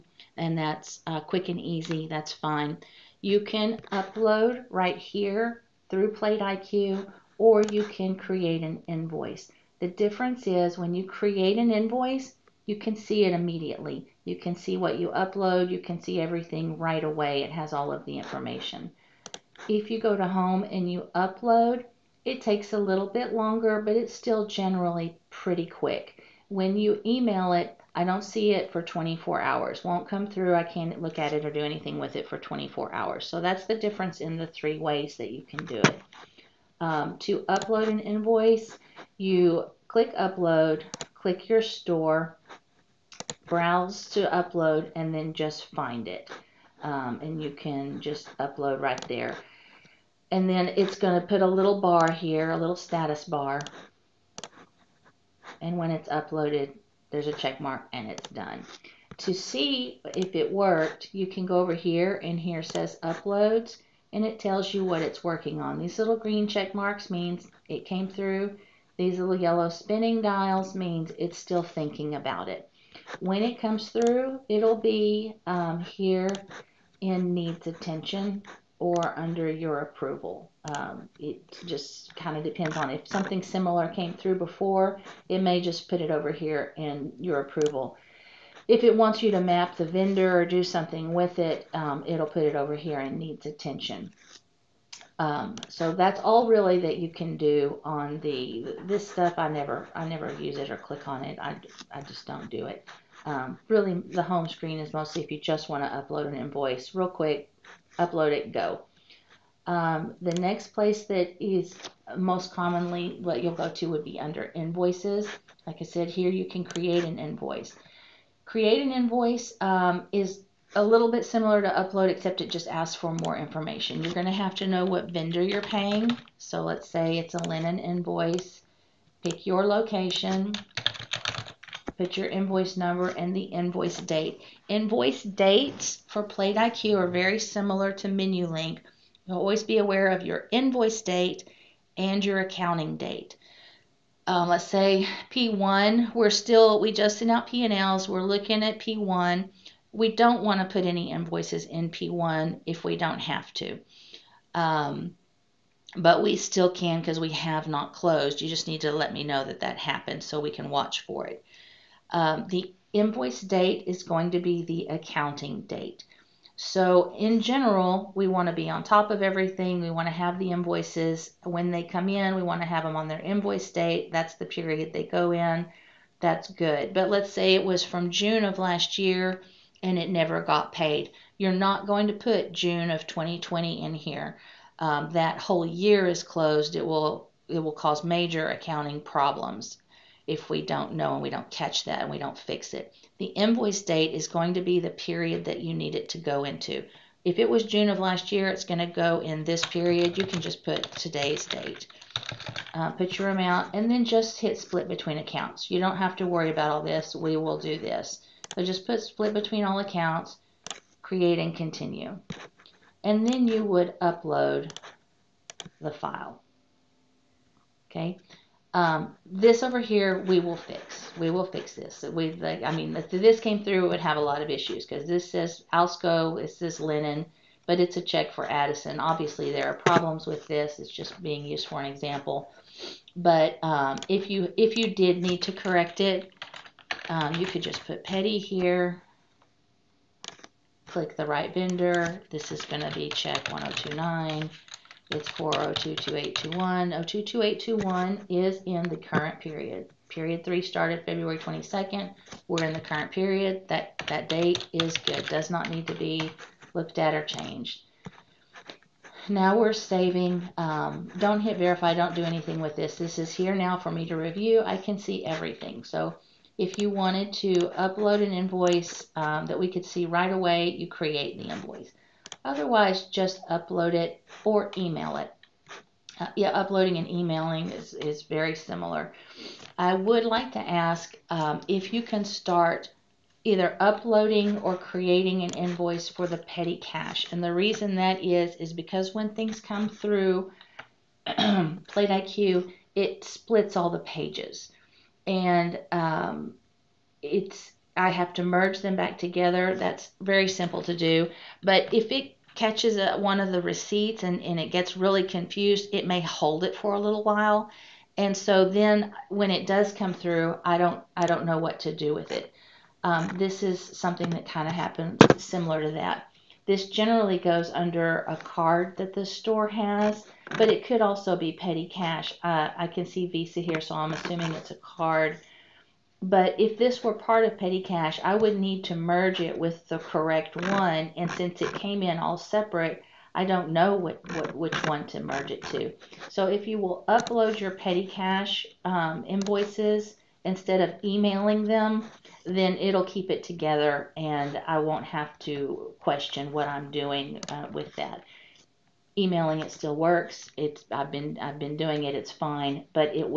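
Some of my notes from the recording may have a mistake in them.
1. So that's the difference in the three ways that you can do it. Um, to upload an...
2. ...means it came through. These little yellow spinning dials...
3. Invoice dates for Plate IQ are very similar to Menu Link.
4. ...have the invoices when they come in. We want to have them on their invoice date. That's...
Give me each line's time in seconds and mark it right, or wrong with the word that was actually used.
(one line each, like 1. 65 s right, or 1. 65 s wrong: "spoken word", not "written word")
1. 33 s right
2. 67 s right
3. 134 s right
4. 170 s right.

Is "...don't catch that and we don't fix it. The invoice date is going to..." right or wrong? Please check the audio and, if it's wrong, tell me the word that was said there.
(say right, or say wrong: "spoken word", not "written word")
right.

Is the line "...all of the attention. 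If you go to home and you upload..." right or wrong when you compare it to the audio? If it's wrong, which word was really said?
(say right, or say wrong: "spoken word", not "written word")
wrong: "information", not "attention".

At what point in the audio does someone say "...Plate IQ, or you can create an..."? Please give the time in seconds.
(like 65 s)
6 s.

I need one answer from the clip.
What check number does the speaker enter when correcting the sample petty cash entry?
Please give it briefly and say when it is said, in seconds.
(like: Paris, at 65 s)
1029, at 243 s.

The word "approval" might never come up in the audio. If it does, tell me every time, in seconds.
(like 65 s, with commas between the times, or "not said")
79 s, 87 s.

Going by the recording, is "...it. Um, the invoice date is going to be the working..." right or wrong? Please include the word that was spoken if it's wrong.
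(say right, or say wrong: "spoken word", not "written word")
wrong: "accounting", not "working".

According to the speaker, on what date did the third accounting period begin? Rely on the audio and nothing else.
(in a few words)
February 22nd.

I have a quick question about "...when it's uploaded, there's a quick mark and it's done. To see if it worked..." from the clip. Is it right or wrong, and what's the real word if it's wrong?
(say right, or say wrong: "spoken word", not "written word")
wrong: "check", not "quick".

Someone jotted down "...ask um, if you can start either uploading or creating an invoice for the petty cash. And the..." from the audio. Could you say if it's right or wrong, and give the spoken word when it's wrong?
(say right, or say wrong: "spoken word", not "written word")
right.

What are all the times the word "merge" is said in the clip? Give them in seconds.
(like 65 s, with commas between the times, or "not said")
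298 s, 328 s, 335 s.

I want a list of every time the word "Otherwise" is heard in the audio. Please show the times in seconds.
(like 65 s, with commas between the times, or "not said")
272 s.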